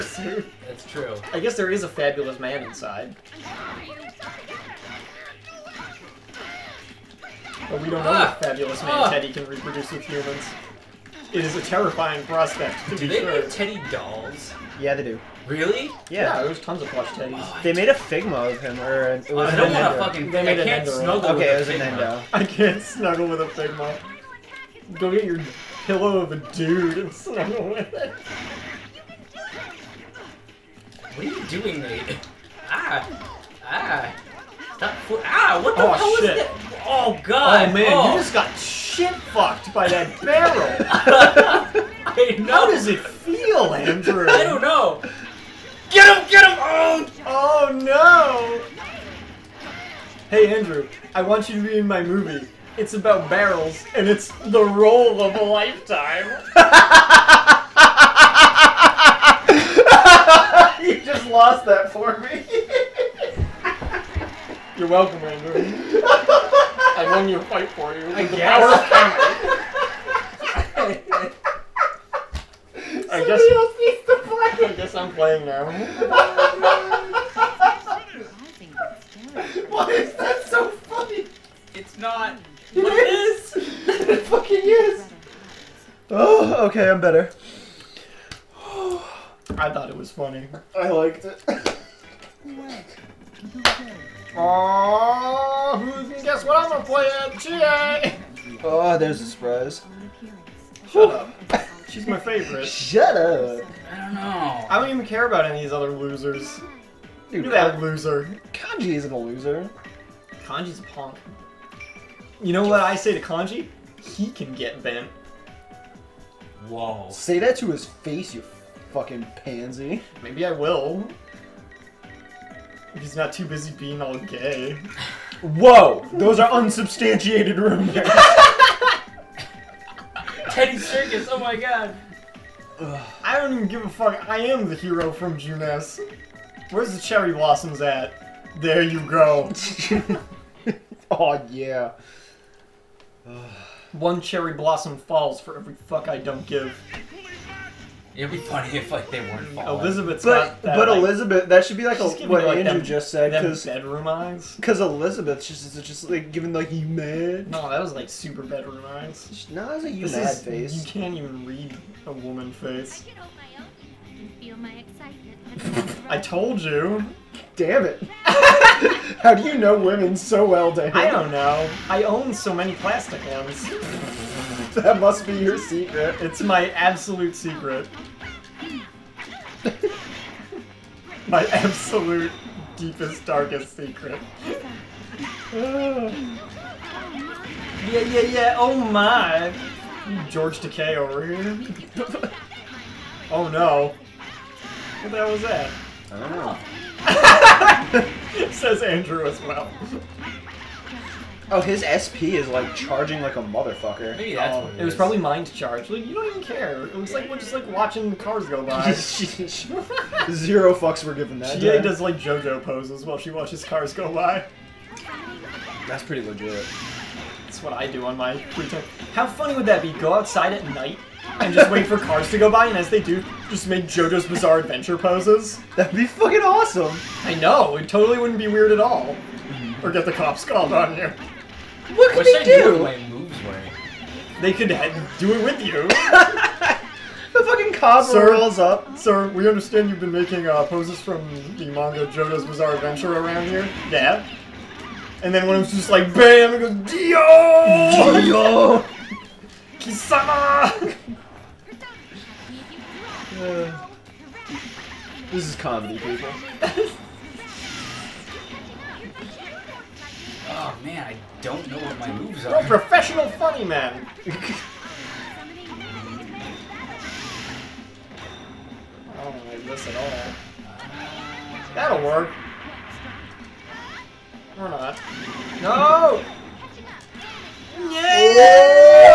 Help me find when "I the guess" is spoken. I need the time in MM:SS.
01:08.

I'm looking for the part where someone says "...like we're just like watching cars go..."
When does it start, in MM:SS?
03:27.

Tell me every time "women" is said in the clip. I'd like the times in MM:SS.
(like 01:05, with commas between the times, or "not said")
02:49.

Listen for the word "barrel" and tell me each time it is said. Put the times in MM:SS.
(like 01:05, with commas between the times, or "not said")
00:40, 00:53.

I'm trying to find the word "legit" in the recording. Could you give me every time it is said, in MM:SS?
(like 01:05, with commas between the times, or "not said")
03:36.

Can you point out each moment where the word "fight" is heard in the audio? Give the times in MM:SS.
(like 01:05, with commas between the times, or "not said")
01:07.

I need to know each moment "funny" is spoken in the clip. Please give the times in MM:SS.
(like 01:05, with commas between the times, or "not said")
01:20, 01:30, 02:28, 03:39, 04:23.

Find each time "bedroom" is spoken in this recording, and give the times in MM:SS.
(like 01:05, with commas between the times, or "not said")
02:33, 02:38.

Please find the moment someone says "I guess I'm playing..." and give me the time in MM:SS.
01:14.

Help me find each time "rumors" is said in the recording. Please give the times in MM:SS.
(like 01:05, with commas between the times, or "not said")
02:07.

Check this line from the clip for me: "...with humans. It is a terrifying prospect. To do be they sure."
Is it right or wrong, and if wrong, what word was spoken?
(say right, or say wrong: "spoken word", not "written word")
right.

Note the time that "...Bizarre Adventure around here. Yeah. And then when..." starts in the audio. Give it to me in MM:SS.
04:02.